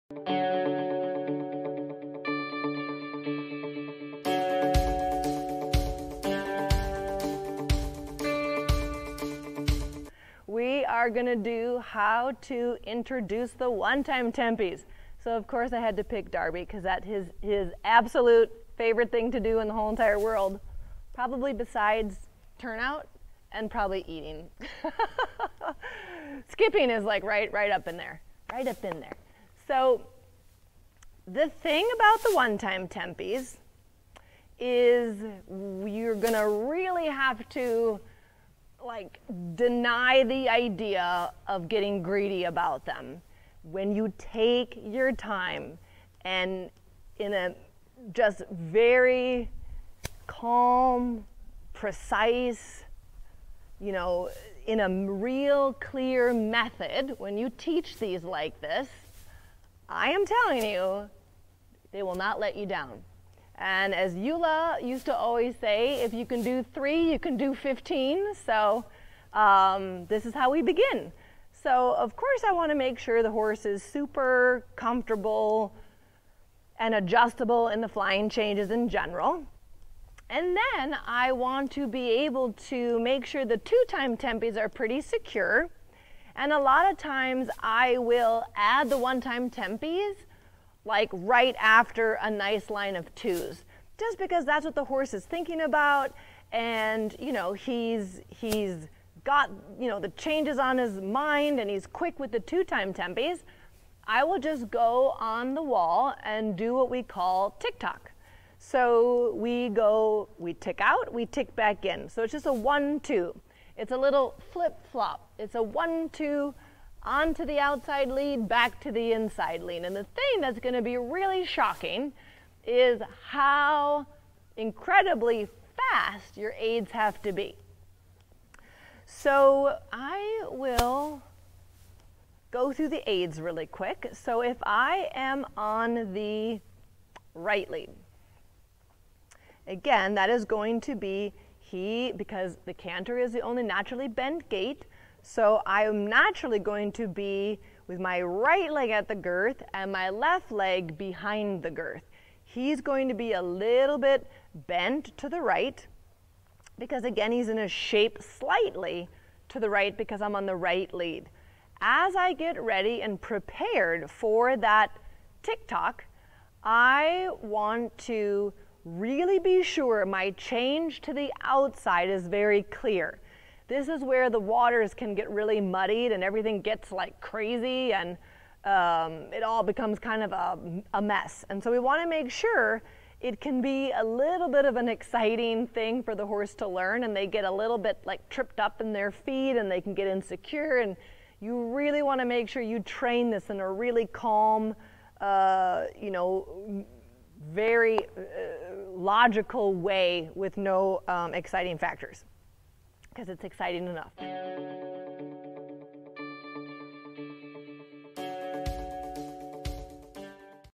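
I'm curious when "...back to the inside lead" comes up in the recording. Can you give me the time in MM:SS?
01:58.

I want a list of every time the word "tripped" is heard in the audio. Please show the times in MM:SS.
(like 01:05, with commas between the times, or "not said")
03:08.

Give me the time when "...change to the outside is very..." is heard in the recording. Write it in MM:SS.
02:50.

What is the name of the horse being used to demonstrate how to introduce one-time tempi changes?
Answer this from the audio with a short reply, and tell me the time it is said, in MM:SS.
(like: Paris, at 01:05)
Derby, at 00:16.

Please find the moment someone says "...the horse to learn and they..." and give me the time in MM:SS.
03:06.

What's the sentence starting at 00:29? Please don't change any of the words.
So the thing about the one-time tempis is you're gonna really have to like deny the idea of getting greedy about them.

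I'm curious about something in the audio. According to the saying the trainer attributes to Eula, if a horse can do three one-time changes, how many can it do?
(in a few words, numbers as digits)
15.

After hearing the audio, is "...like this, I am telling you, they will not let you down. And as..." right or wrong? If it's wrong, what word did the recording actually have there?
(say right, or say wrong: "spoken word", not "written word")
right.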